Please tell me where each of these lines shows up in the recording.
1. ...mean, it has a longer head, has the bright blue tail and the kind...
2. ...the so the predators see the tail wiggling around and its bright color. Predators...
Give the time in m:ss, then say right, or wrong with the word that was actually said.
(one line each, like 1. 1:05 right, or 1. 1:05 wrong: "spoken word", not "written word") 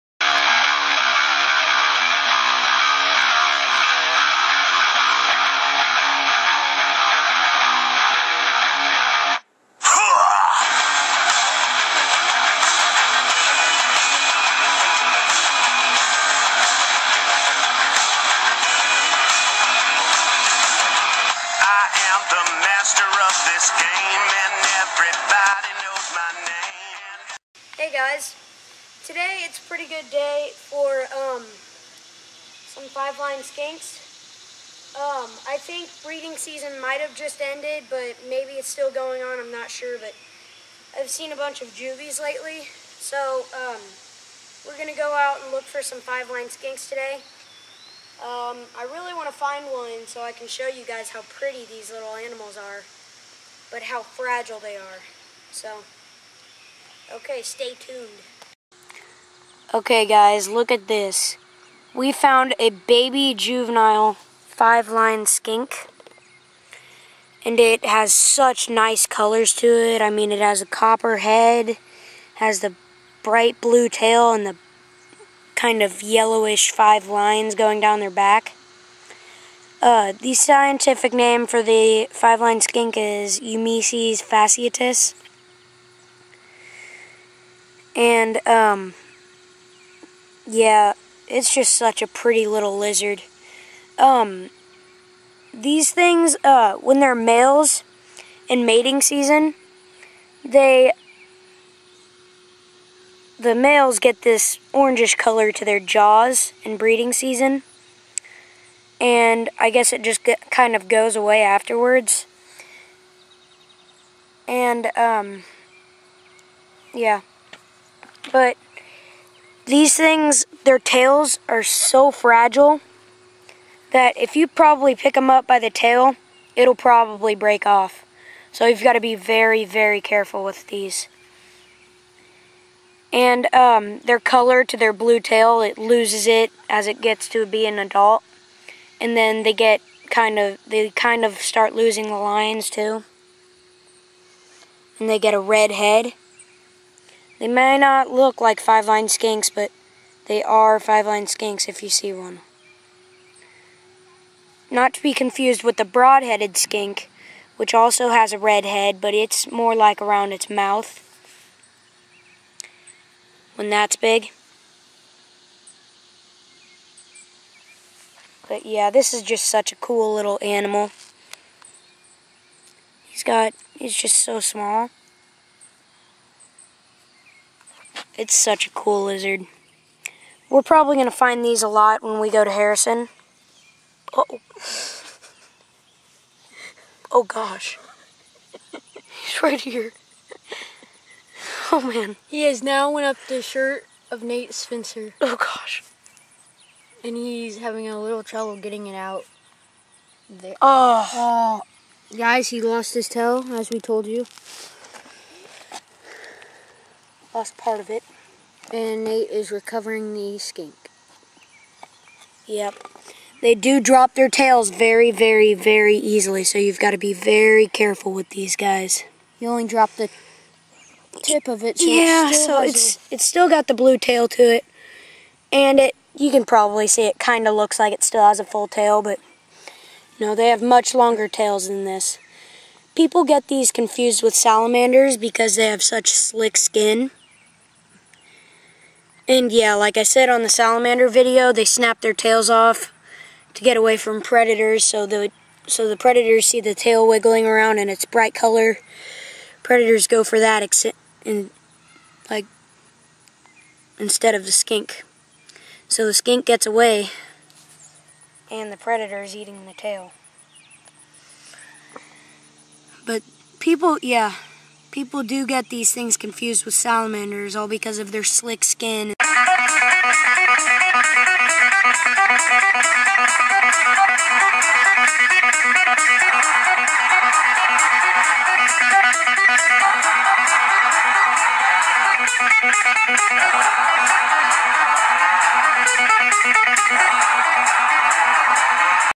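1. 1:10 wrong: "copper", not "longer"
2. 4:05 right.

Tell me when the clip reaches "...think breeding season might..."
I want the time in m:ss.
0:35.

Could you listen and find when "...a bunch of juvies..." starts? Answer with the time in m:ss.
0:41.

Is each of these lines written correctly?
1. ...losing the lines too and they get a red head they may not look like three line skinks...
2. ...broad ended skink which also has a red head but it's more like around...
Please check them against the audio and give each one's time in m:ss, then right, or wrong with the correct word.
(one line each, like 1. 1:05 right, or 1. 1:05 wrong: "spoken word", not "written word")
1. 2:21 wrong: "five", not "three"
2. 2:35 wrong: "headed", not "ended".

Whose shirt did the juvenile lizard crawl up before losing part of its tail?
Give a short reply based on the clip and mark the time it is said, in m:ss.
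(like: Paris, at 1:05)
Nate Spencer, at 3:14.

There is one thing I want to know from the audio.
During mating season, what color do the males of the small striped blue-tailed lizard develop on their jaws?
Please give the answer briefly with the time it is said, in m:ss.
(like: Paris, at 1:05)
orangish, at 1:44.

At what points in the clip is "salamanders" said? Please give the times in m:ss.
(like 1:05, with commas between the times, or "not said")
3:54, 4:00, 4:26.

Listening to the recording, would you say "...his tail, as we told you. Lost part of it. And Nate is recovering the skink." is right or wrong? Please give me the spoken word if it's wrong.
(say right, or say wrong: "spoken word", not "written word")
right.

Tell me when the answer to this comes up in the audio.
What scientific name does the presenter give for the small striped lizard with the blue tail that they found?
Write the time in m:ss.
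1:23.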